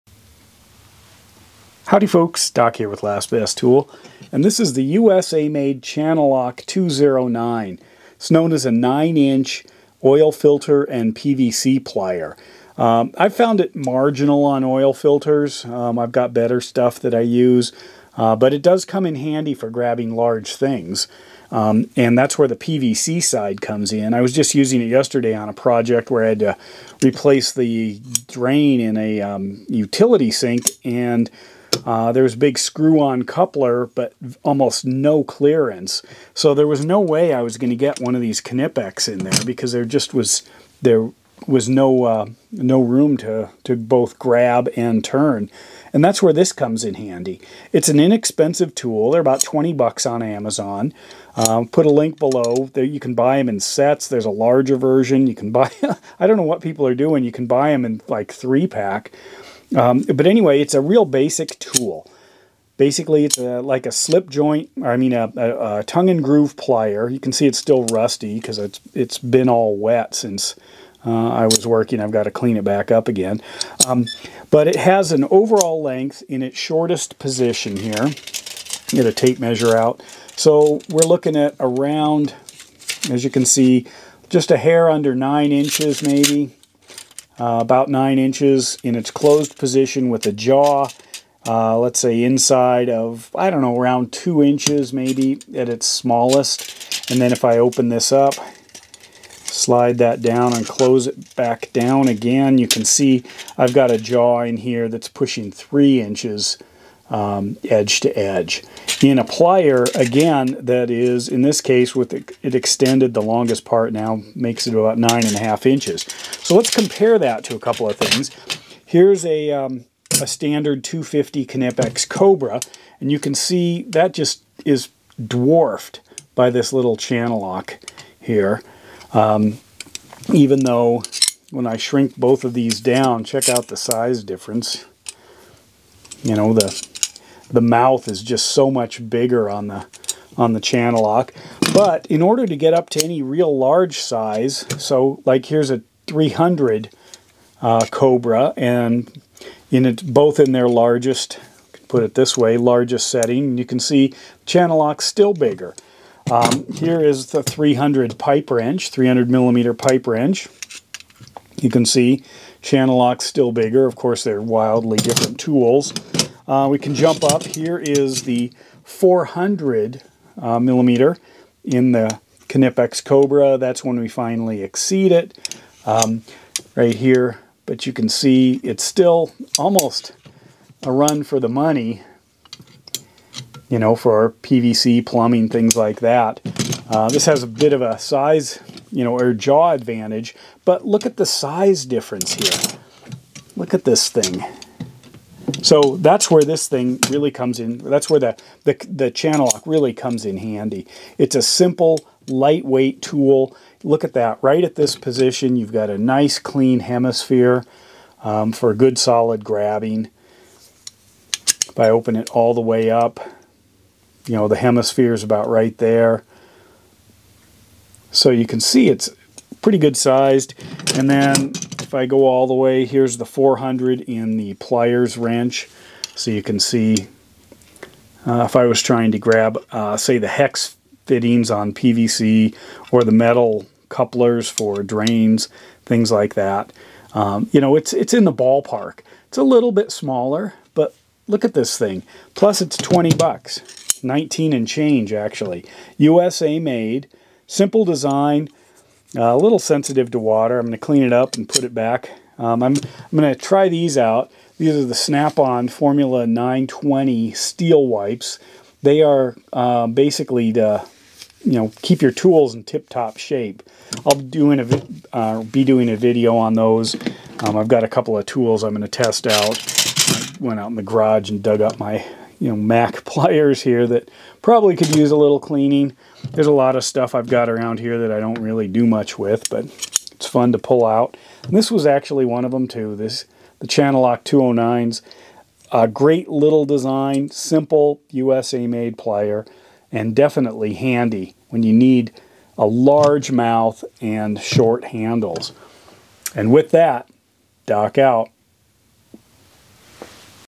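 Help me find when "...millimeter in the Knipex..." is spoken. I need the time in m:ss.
2:50.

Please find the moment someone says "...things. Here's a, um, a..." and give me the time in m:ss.
1:57.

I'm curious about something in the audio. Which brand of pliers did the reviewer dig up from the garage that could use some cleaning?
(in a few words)
Mac.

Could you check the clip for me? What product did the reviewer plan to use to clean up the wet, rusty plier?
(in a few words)
Snap-on Formula 920 steel wipes.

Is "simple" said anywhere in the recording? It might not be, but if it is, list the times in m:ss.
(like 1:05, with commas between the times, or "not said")
3:21, 4:07, 4:47.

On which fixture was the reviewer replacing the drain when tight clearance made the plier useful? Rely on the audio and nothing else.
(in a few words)
utility sink.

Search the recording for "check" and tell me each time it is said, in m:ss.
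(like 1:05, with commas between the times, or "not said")
2:13.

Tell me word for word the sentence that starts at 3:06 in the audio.
Uh, this has a bit of a size, you know, or jaw advantage, but look at the size difference here.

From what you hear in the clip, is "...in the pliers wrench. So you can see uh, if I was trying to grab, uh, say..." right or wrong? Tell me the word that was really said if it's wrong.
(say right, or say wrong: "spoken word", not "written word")
right.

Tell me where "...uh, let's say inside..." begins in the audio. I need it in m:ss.
1:31.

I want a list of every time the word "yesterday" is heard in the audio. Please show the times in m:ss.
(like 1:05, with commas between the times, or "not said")
0:24.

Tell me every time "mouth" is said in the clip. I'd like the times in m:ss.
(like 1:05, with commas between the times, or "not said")
2:17, 4:53.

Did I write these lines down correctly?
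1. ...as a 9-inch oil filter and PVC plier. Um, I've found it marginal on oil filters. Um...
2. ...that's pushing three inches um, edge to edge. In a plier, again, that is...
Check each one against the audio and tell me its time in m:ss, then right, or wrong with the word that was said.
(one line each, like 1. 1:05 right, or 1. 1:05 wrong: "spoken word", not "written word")
1. 0:08 right
2. 1:44 right.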